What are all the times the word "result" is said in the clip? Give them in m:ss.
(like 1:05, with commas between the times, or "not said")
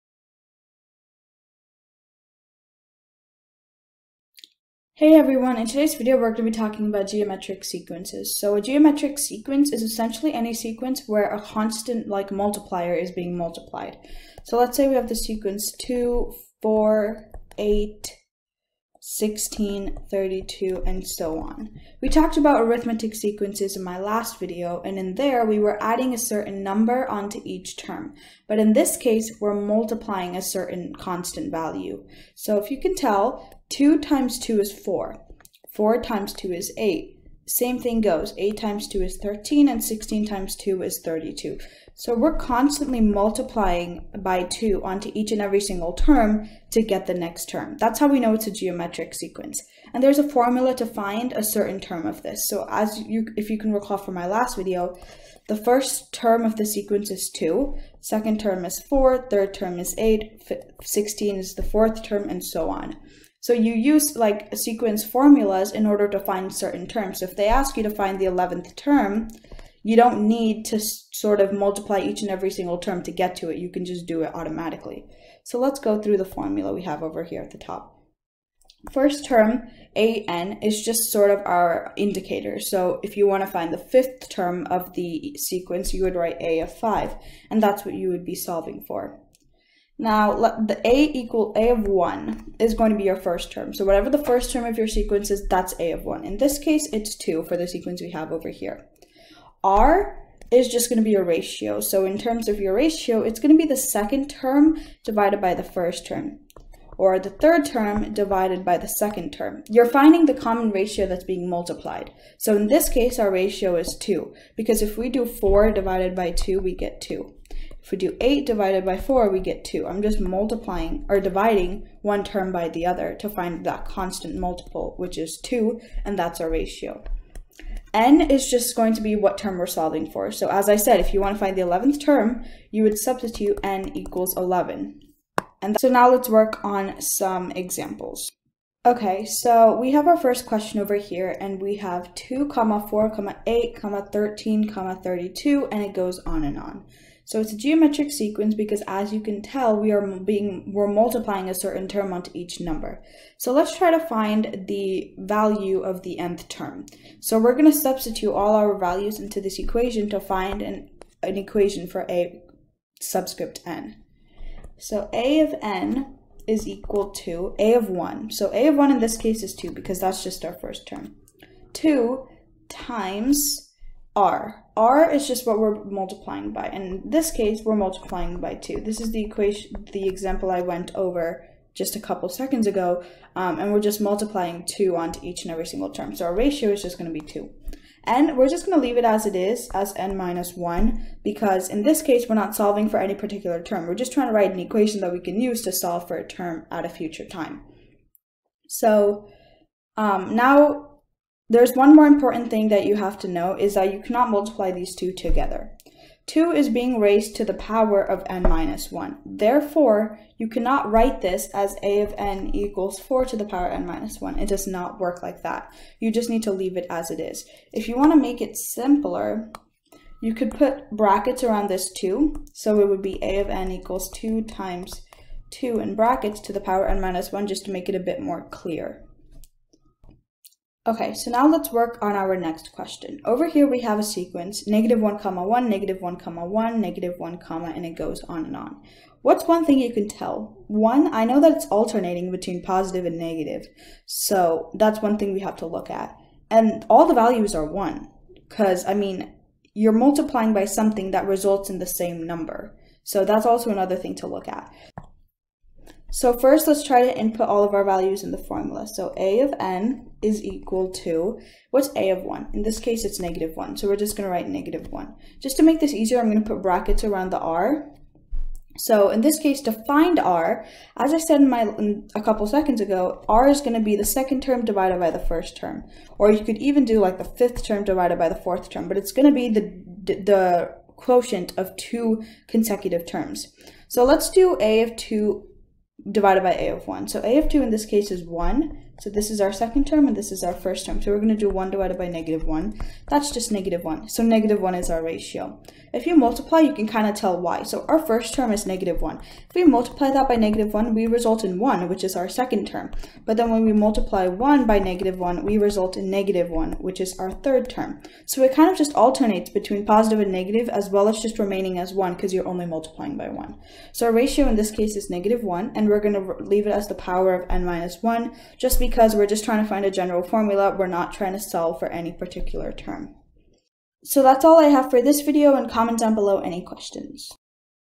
4:11, 5:01, 5:05.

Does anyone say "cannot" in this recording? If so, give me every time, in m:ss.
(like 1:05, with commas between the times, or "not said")
3:23, 3:30.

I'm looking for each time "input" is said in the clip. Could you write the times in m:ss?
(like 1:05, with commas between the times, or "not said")
4:17.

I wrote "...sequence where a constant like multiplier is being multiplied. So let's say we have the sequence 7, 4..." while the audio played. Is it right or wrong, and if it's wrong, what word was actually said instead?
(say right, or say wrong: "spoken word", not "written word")
wrong: "2", not "7".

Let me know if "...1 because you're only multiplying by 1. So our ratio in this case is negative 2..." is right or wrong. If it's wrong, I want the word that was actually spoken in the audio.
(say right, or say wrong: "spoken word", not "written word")
wrong: "1", not "2".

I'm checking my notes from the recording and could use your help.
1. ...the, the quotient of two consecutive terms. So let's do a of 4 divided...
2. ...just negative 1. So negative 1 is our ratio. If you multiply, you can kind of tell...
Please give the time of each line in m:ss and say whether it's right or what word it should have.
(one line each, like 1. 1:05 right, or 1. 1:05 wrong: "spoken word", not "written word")
1. 4:39 wrong: "2", not "4"
2. 4:53 right.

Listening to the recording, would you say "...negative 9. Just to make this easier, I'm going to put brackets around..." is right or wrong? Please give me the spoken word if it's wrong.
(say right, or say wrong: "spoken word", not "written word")
wrong: "1", not "9".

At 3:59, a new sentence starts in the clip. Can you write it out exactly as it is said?
What's one thing you can tell?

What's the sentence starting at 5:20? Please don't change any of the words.
We're not trying to solve for any particular term.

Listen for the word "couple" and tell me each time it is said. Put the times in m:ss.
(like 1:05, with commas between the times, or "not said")
3:02, 4:32.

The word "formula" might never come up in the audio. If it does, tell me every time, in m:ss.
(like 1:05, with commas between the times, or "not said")
0:50, 1:05, 1:16, 4:18, 5:20.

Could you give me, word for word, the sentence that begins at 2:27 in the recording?
So it's a geometric sequence because as you can tell, we are being, we're multiplying a certain term onto each number.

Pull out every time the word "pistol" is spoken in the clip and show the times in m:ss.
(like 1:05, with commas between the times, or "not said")
not said.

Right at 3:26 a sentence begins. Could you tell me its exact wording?
2 is being raised to the power of n minus 1.